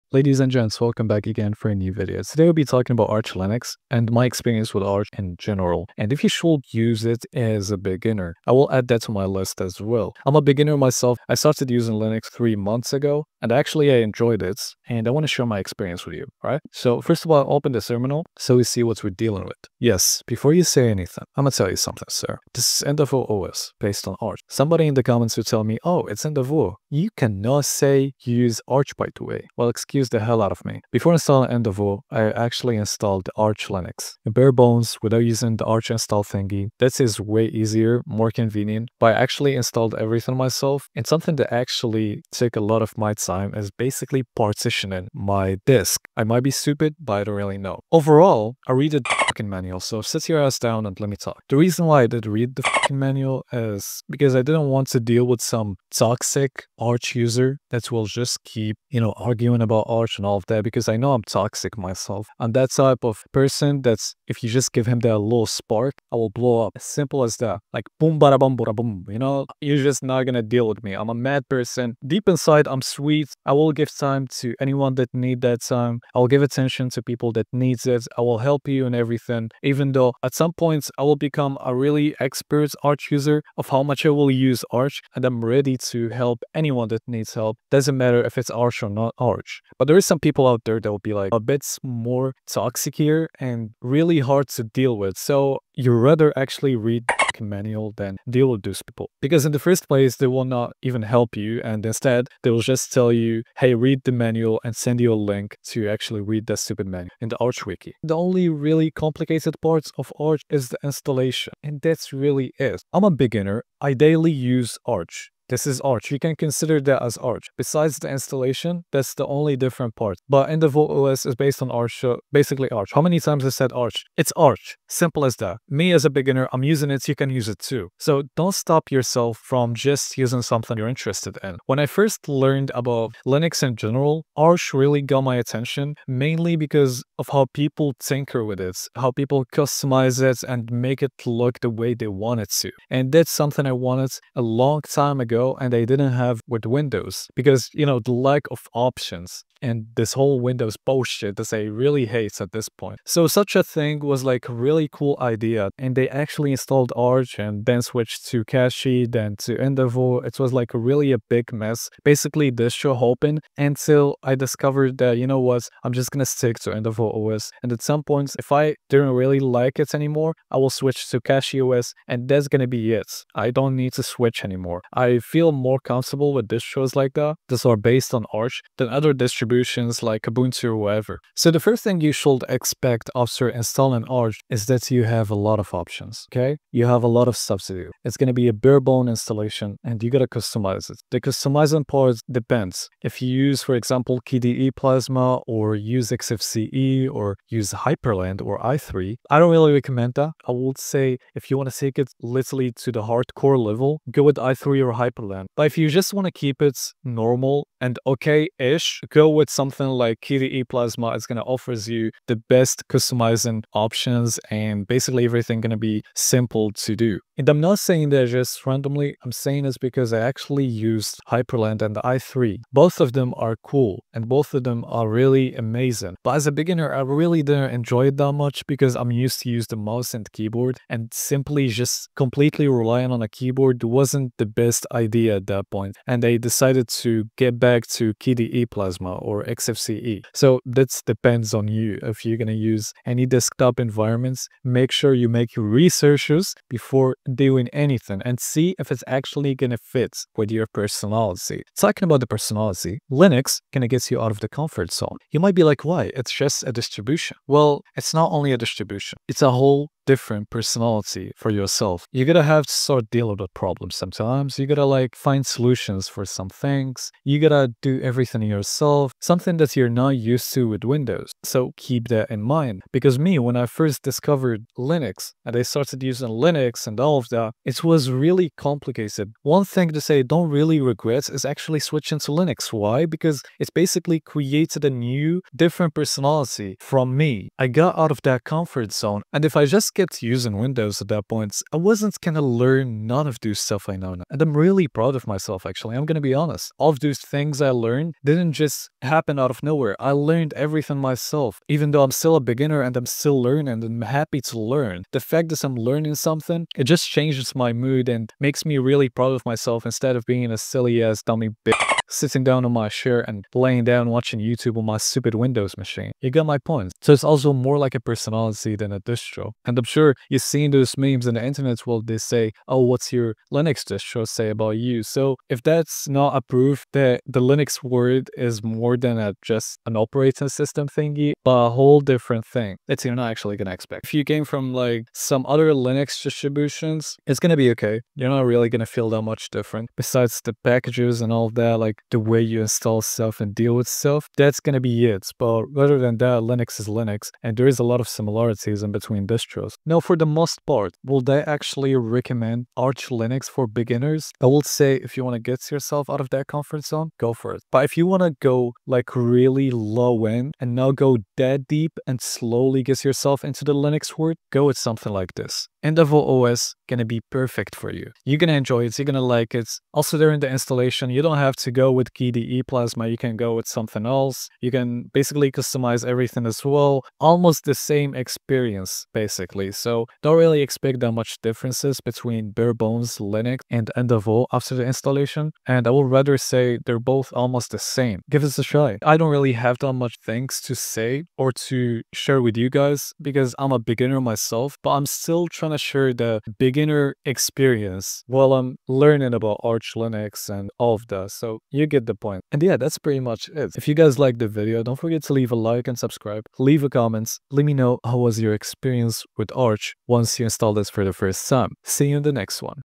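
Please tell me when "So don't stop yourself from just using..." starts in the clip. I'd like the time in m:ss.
2:07.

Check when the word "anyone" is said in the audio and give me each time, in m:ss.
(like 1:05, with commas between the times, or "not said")
1:14, 1:26.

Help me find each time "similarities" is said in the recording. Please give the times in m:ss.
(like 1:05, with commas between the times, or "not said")
5:48.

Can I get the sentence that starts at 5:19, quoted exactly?
And I'm sure you've seen those memes in the internet where they say, oh, what's your Linux distro say about you?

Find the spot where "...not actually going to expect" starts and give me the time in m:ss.
5:33.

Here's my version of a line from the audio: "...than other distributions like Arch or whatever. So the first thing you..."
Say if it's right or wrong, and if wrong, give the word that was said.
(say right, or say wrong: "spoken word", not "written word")
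wrong: "Ubuntu", not "Arch".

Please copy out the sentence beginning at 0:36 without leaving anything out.
This is way easier, more convenient, but I actually installed everything myself.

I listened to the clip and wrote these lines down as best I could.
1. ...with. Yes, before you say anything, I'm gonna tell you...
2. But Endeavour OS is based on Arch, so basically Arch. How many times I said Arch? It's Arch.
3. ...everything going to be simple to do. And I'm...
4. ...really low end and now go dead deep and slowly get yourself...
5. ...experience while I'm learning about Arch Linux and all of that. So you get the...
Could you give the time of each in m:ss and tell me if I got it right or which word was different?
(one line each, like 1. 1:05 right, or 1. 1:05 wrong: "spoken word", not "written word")
1. 0:19 right
2. 2:00 right
3. 3:35 right
4. 5:59 right
5. 6:37 right.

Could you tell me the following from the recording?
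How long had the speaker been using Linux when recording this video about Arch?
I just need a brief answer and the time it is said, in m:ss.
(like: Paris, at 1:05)
3 months, at 0:12.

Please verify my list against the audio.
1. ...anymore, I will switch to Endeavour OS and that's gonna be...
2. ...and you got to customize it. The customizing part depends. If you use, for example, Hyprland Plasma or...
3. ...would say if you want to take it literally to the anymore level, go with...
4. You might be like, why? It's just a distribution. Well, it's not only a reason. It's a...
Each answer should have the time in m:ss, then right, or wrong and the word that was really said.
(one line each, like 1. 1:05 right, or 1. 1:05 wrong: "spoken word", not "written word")
1. 2:49 wrong: "Cachy", not "Endeavour"
2. 3:09 wrong: "KDE", not "Hyprland"
3. 3:20 wrong: "hardcore", not "anymore"
4. 4:15 wrong: "distribution", not "reason".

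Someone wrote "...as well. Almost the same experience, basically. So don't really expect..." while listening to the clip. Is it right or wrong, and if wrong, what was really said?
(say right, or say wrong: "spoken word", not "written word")
right.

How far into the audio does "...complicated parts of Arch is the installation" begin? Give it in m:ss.
1:48.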